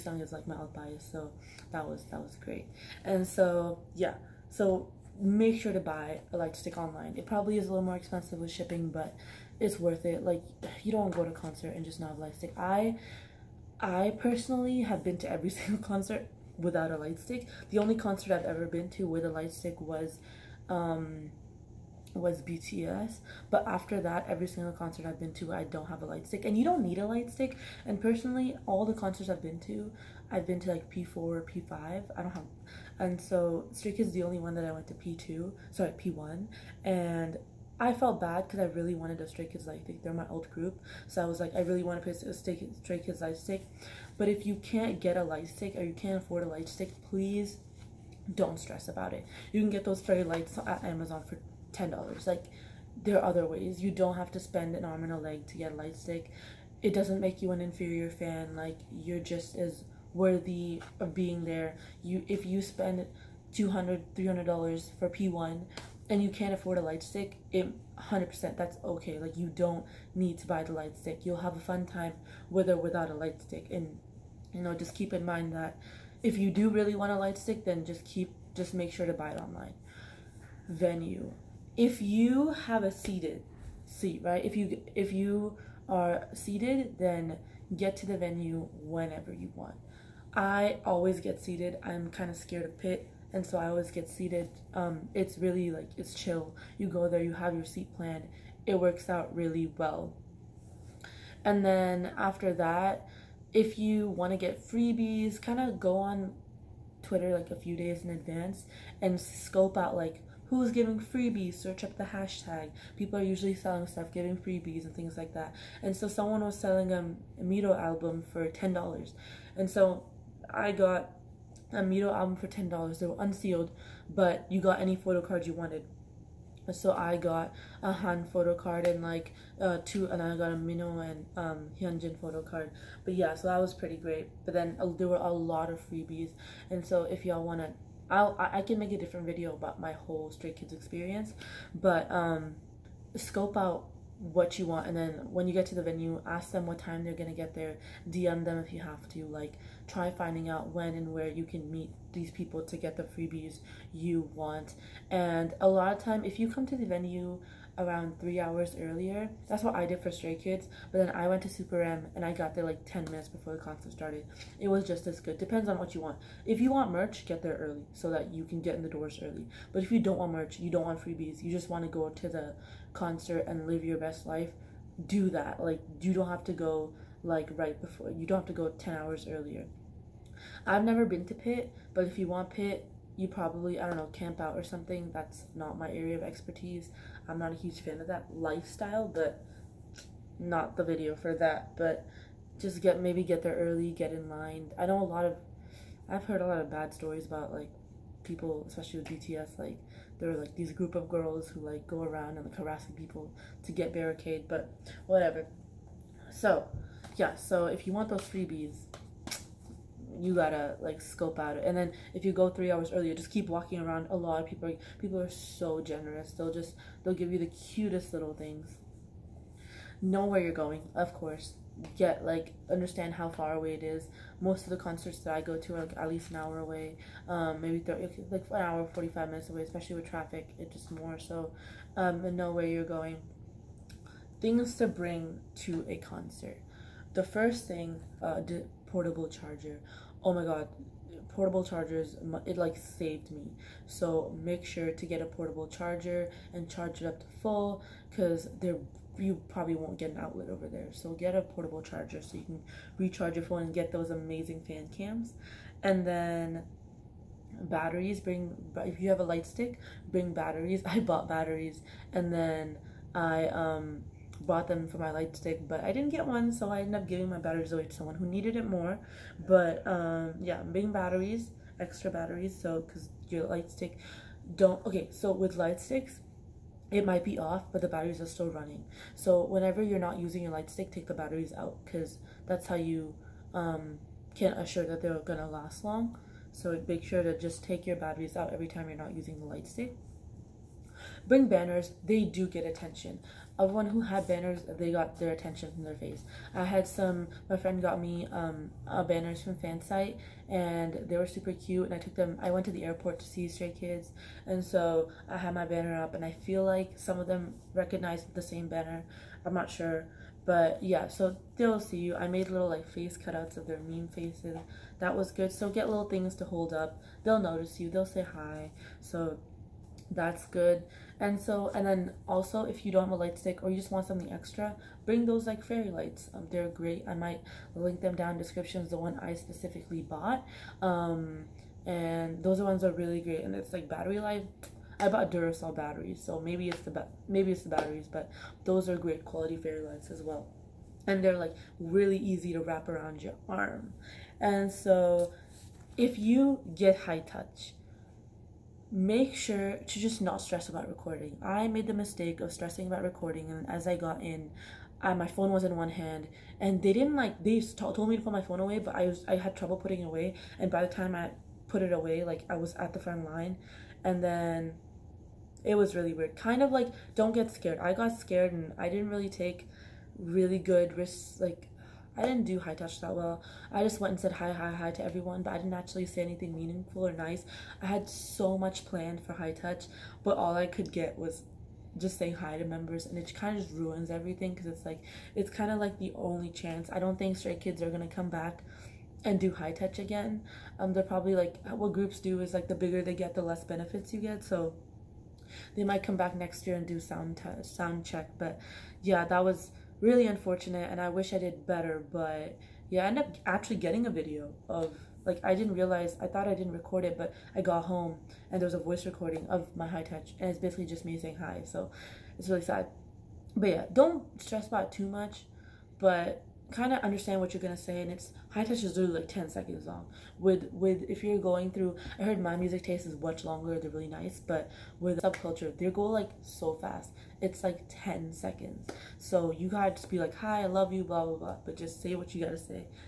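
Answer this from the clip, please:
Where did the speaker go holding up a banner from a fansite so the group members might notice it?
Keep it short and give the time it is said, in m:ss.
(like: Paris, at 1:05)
the airport, at 5:02.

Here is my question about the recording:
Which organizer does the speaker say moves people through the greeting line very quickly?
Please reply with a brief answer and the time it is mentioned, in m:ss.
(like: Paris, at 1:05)
SubKulture, at 7:05.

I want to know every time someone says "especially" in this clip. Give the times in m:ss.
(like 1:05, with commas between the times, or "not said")
3:18, 3:49.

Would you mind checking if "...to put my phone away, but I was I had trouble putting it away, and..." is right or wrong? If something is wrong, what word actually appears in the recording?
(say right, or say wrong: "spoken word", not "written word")
right.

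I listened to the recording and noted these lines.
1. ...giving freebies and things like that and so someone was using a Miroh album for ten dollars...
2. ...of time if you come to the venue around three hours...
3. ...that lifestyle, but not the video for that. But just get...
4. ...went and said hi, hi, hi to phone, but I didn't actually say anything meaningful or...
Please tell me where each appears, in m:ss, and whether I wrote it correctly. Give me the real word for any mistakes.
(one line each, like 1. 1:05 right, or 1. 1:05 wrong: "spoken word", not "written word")
1. 1:54 wrong: "selling", not "using"
2. 2:35 right
3. 3:08 right
4. 6:14 wrong: "everyone", not "phone".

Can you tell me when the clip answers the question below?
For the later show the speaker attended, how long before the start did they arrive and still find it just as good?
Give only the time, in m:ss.
2:42.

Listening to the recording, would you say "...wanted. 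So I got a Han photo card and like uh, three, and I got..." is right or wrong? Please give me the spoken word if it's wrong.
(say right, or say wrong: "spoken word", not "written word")
wrong: "two", not "three".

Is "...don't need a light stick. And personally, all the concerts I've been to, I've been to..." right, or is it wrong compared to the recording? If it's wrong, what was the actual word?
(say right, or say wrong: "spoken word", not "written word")
right.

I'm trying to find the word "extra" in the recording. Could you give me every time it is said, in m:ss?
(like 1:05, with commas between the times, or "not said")
4:31, 5:24.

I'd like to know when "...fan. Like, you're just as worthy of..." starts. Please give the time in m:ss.
0:58.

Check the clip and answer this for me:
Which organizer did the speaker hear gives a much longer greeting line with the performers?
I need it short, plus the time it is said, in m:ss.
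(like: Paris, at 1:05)
MyMusicTaste, at 7:02.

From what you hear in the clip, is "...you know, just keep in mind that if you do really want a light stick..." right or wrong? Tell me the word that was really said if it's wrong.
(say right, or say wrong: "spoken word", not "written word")
right.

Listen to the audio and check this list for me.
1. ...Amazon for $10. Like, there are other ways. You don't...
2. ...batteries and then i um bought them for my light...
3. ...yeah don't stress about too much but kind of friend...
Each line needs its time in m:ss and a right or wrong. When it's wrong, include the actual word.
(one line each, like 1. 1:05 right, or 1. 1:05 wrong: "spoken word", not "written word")
1. 0:50 right
2. 4:21 right
3. 6:53 wrong: "understand", not "friend".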